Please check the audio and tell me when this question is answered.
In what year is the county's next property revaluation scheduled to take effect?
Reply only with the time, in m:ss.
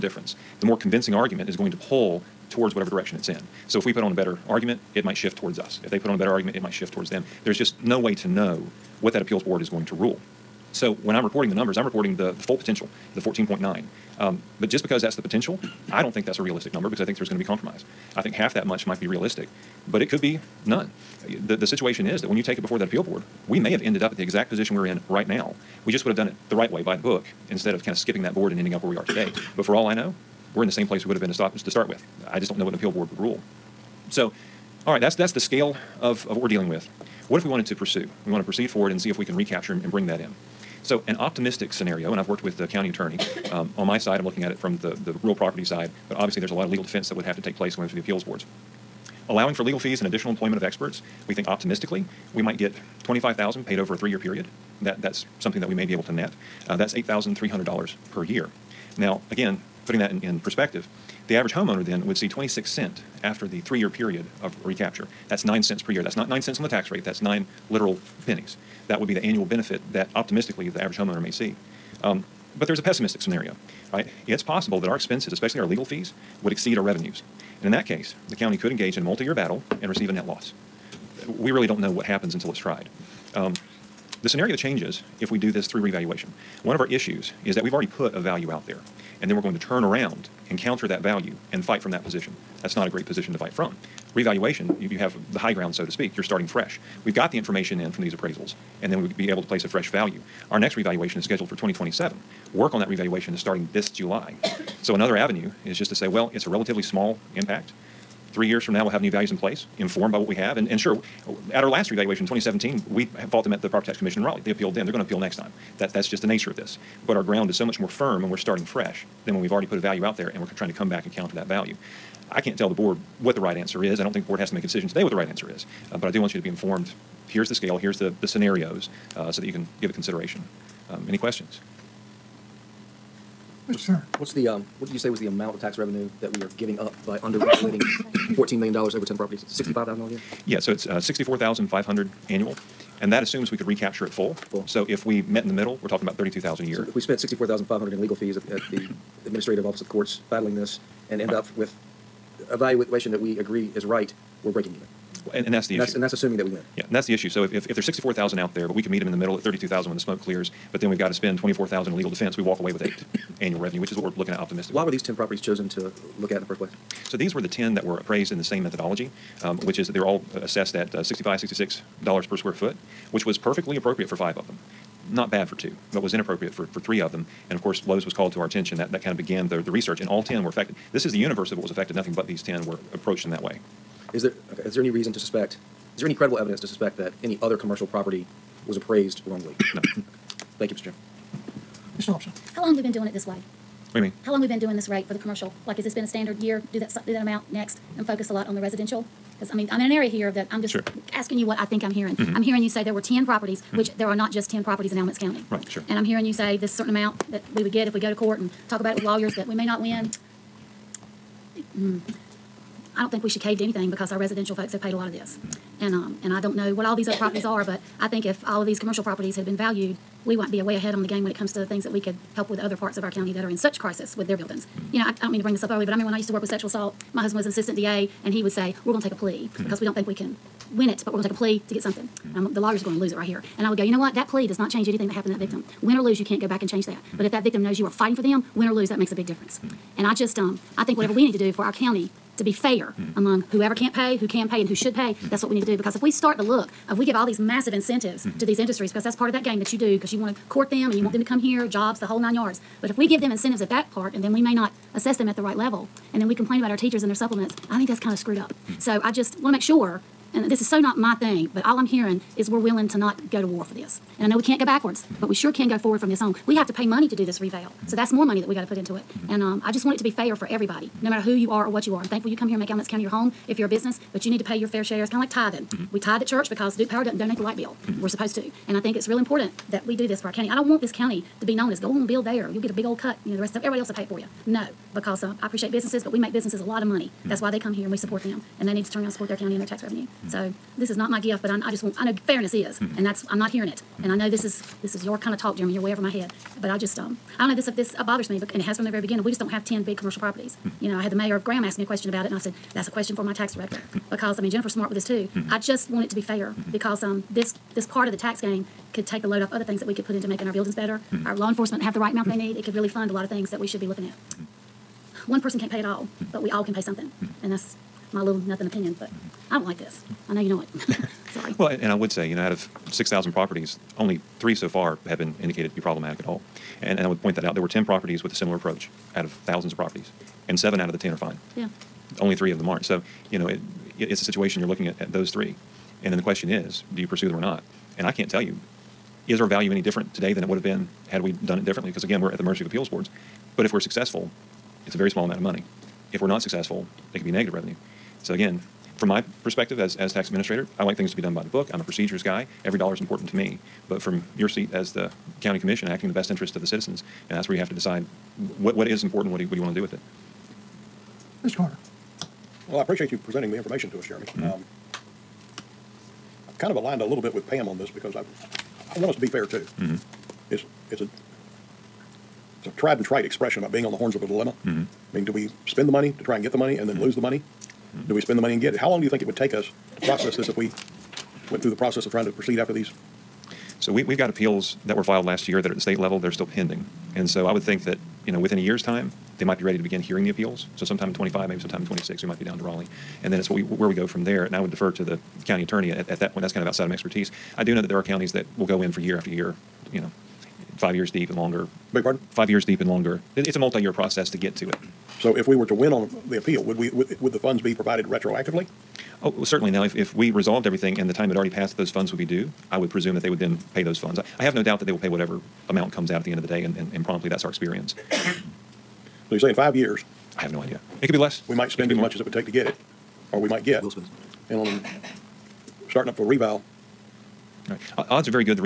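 1:41.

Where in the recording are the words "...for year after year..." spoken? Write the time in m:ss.
6:38.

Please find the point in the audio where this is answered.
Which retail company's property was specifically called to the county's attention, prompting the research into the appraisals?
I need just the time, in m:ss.
2:57.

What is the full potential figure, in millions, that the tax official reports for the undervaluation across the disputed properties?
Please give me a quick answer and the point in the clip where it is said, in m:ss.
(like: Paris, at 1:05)
14.9, at 0:13.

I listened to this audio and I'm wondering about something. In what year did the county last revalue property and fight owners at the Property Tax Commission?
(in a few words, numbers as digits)
2017.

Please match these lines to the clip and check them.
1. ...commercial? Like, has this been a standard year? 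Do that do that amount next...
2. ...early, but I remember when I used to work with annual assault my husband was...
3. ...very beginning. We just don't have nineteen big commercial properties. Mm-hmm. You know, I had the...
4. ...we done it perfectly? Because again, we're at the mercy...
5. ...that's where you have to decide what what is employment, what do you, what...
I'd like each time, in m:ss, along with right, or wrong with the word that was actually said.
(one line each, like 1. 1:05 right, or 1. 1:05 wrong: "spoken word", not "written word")
1. 3:15 right
2. 3:45 wrong: "sexual", not "annual"
3. 4:58 wrong: "ten", not "nineteen"
4. 5:41 wrong: "differently", not "perfectly"
5. 5:57 wrong: "important", not "employment".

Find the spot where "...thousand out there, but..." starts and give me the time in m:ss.
2:38.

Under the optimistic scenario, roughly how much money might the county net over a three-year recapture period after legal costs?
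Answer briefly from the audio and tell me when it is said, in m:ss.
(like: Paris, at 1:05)
25,000, at 0:53.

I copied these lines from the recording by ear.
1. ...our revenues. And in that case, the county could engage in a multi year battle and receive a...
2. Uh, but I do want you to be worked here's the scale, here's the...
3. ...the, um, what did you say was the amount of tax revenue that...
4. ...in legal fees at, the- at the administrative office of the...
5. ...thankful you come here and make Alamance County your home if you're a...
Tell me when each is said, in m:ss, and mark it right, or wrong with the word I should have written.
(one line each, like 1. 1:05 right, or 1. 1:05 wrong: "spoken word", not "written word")
1. 1:16 right
2. 2:05 wrong: "informed", not "worked"
3. 2:14 right
4. 2:27 right
5. 4:32 right.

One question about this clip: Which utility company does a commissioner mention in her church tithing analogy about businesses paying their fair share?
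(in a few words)
Duke Power.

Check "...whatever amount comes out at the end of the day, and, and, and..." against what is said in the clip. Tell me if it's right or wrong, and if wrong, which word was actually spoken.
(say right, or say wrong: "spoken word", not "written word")
right.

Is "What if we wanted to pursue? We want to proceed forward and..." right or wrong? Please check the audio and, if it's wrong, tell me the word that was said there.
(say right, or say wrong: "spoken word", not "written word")
right.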